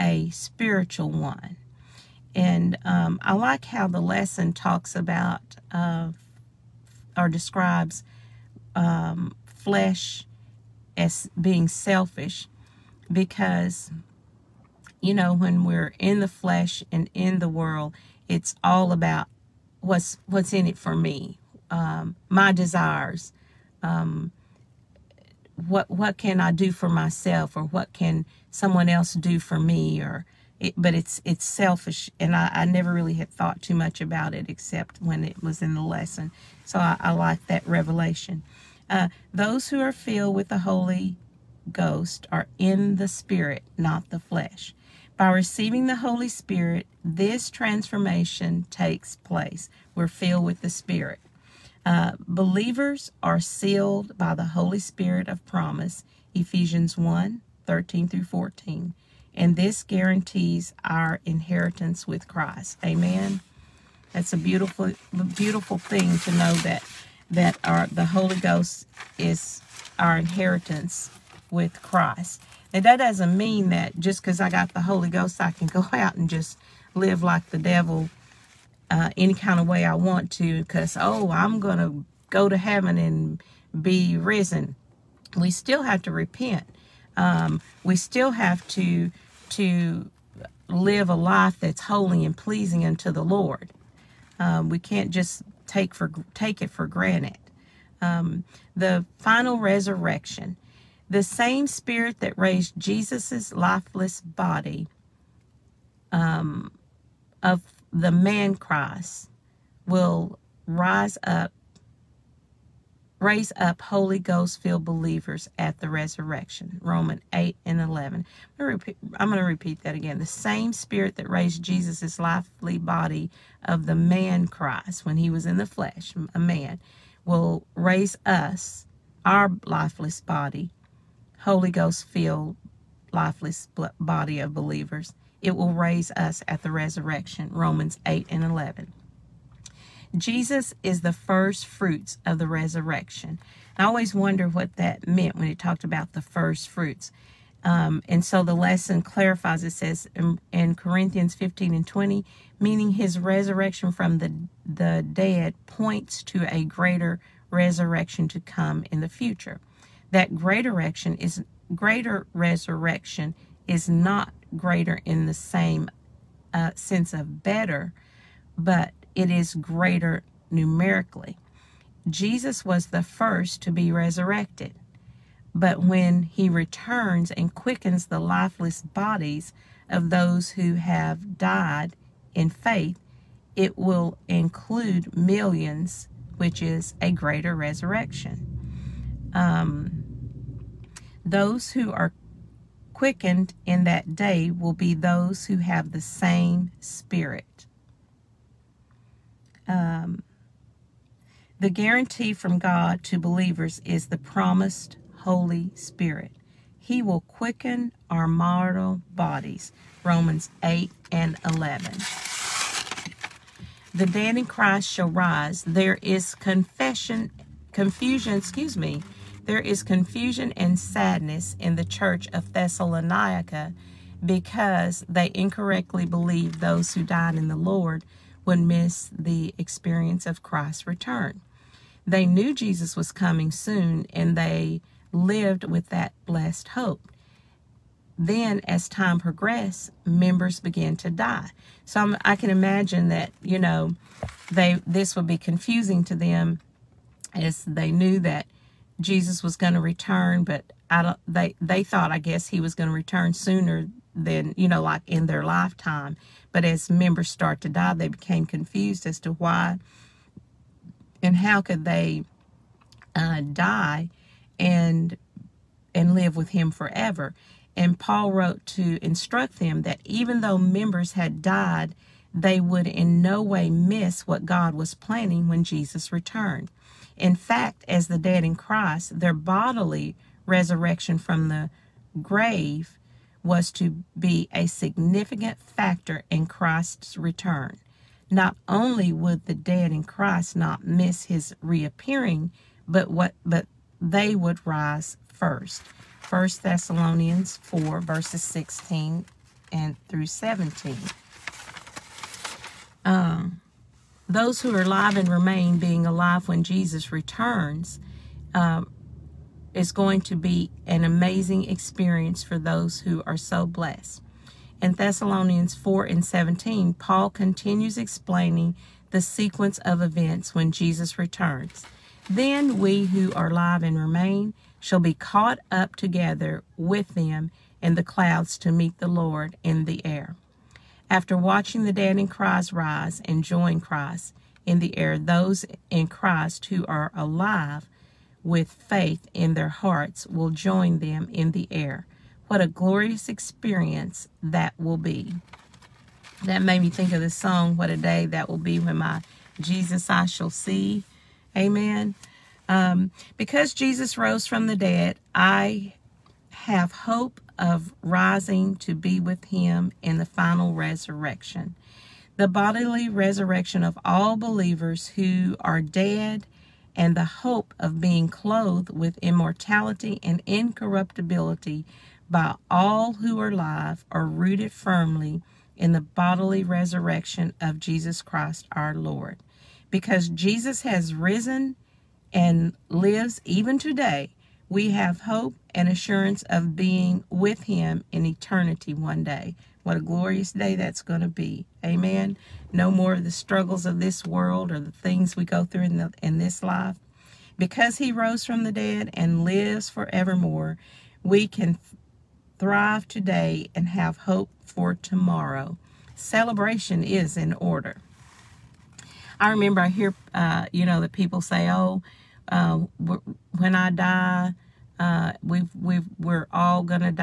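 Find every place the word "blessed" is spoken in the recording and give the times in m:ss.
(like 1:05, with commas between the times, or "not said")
3:56, 5:13.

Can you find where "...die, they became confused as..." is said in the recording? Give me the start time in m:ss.
4:17.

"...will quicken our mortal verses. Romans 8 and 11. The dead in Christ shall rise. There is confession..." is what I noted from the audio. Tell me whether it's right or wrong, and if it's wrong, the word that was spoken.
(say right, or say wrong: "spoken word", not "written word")
wrong: "bodies", not "verses".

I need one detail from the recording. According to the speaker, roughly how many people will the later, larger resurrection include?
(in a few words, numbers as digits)
Millions.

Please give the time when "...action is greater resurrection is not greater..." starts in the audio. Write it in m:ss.
2:40.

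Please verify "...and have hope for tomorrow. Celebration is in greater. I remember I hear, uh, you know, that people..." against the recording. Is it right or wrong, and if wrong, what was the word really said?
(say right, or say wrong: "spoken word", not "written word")
wrong: "order", not "greater".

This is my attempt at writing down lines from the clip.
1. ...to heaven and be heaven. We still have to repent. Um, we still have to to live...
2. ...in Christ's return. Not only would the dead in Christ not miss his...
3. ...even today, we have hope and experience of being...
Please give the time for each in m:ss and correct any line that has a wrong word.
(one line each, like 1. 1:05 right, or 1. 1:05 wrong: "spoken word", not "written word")
1. 1:22 wrong: "risen", not "heaven"
2. 4:46 right
3. 6:23 wrong: "assurance", not "experience".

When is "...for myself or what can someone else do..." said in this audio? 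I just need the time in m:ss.
0:26.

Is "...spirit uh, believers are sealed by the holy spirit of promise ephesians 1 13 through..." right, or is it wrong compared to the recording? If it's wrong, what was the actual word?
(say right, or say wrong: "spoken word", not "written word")
right.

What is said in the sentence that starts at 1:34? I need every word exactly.
Um, we can't just take for take it for granted.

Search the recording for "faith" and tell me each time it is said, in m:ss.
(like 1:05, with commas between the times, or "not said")
3:02, 5:38.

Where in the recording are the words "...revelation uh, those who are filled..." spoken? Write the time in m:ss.
0:37.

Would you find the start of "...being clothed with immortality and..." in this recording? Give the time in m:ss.
6:08.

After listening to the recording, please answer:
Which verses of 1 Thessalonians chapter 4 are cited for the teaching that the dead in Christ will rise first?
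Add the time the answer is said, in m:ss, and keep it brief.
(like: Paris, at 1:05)
16-17, at 4:58.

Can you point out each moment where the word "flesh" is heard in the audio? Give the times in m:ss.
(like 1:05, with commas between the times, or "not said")
0:09, 0:16, 0:44, 2:05.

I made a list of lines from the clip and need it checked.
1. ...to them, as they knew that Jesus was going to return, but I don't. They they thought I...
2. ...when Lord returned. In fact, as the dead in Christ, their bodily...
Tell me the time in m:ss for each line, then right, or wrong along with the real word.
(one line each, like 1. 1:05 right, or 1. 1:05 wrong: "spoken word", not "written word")
1. 4:06 right
2. 4:35 wrong: "Jesus", not "Lord".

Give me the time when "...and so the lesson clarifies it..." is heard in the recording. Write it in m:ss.
2:28.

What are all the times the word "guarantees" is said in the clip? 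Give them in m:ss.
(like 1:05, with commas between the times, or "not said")
0:59, 3:21.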